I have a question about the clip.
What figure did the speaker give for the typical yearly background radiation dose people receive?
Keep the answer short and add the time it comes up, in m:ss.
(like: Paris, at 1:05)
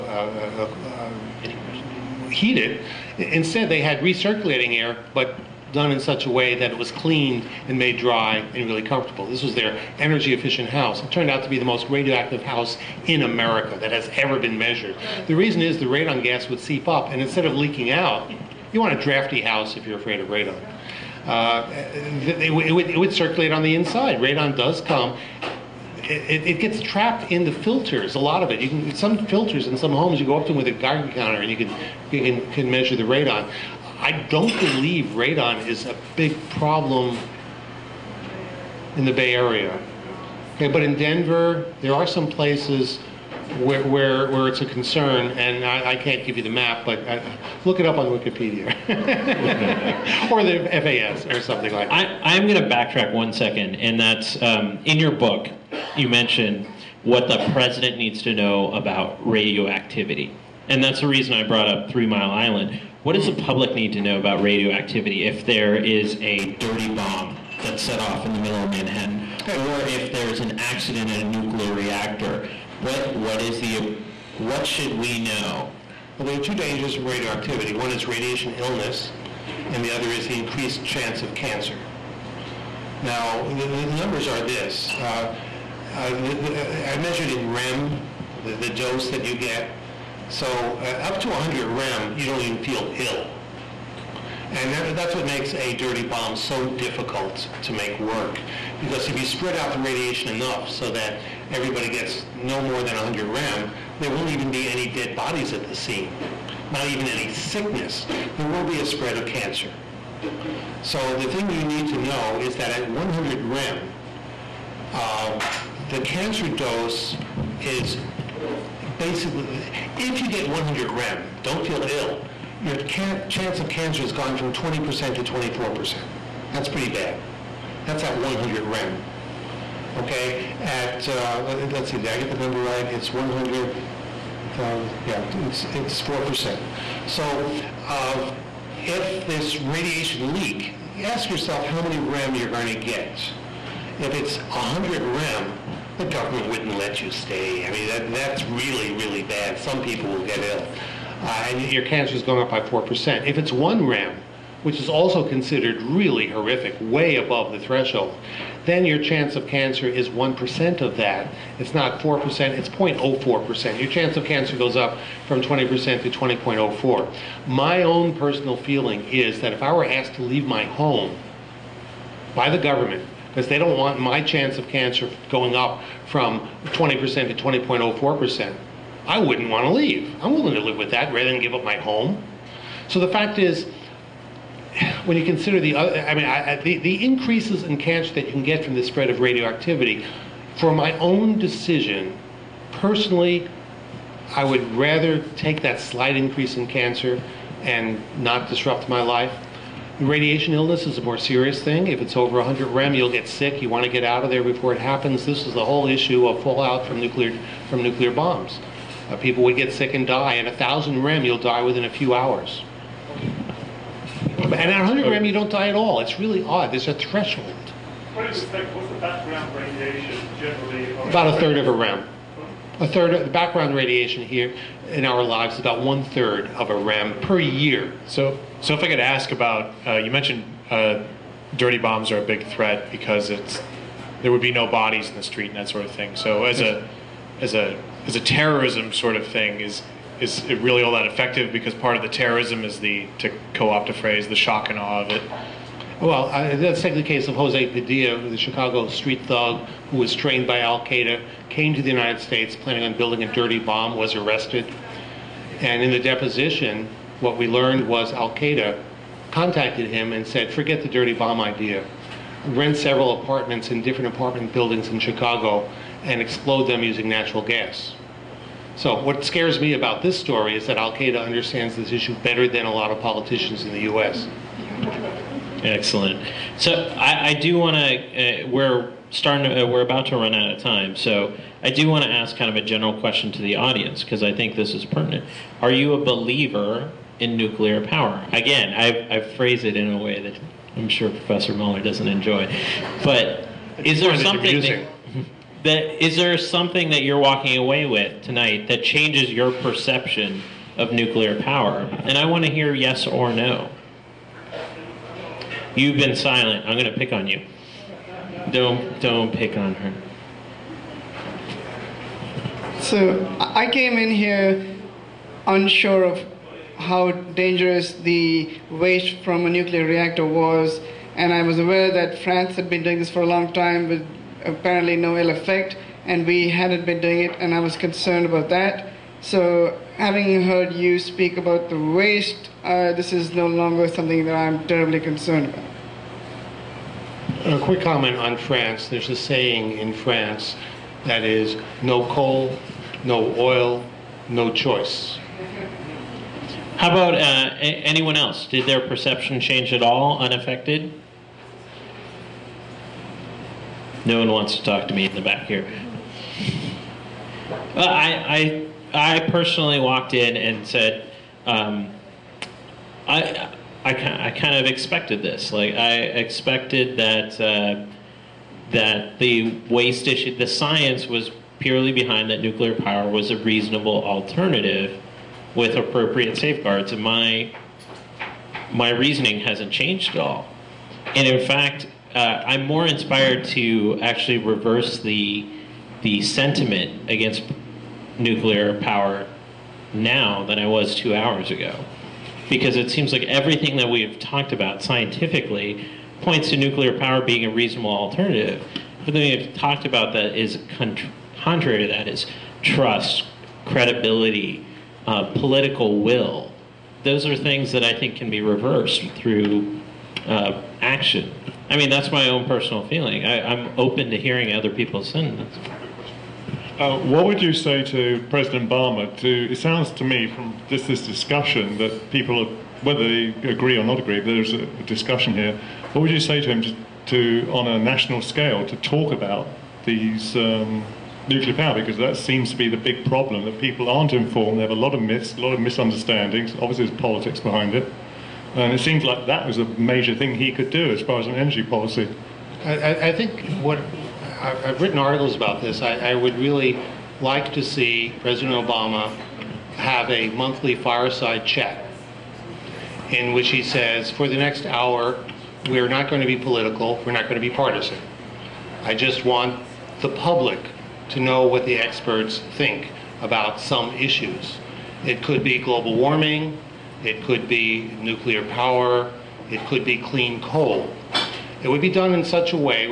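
A third of a rem, at 3:41.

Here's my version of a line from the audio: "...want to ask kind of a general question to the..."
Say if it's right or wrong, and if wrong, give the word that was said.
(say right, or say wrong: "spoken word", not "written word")
right.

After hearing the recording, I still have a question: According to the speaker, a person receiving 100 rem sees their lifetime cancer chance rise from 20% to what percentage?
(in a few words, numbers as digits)
24%.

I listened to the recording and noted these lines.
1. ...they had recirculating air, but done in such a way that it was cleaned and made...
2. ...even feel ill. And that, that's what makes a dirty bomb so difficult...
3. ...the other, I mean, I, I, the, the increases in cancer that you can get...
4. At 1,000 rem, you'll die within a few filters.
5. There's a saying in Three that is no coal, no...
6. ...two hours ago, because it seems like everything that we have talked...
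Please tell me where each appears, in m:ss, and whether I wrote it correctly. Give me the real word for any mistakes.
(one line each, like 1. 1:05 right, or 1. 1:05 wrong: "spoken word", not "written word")
1. 0:03 right
2. 1:32 right
3. 3:05 right
4. 3:30 wrong: "hours", not "filters"
5. 5:38 wrong: "France", not "Three"
6. 6:30 right.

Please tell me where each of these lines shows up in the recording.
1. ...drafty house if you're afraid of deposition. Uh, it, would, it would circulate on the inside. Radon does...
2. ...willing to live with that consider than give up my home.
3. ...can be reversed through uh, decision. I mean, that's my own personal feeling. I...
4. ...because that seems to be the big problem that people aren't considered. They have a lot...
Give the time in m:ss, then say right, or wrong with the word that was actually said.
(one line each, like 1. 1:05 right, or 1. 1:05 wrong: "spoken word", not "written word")
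1. 0:19 wrong: "radon", not "deposition"
2. 3:00 wrong: "rather", not "consider"
3. 6:48 wrong: "action", not "decision"
4. 7:11 wrong: "informed", not "considered".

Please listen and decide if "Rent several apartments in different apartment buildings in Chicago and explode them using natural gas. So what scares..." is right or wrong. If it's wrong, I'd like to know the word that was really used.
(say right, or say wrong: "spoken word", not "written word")
right.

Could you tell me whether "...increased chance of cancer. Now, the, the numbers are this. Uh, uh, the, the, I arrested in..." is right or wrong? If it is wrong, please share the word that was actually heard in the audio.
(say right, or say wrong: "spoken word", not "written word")
wrong: "measured", not "arrested".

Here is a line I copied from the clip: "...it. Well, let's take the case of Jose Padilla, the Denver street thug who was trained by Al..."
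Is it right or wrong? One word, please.
wrong.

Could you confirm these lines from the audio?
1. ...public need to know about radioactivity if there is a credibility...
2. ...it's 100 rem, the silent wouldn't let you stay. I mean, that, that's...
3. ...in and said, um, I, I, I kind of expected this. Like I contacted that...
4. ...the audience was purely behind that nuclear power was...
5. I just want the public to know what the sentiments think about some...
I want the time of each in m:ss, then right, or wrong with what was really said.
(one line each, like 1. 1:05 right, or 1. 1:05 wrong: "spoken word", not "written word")
1. 1:03 wrong: "dirty", not "credibility"
2. 2:24 wrong: "government", not "silent"
3. 6:00 wrong: "expected", not "contacted"
4. 6:10 wrong: "science", not "audience"
5. 7:38 wrong: "experts", not "sentiments".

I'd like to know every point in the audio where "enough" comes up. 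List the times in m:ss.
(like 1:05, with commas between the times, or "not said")
1:40.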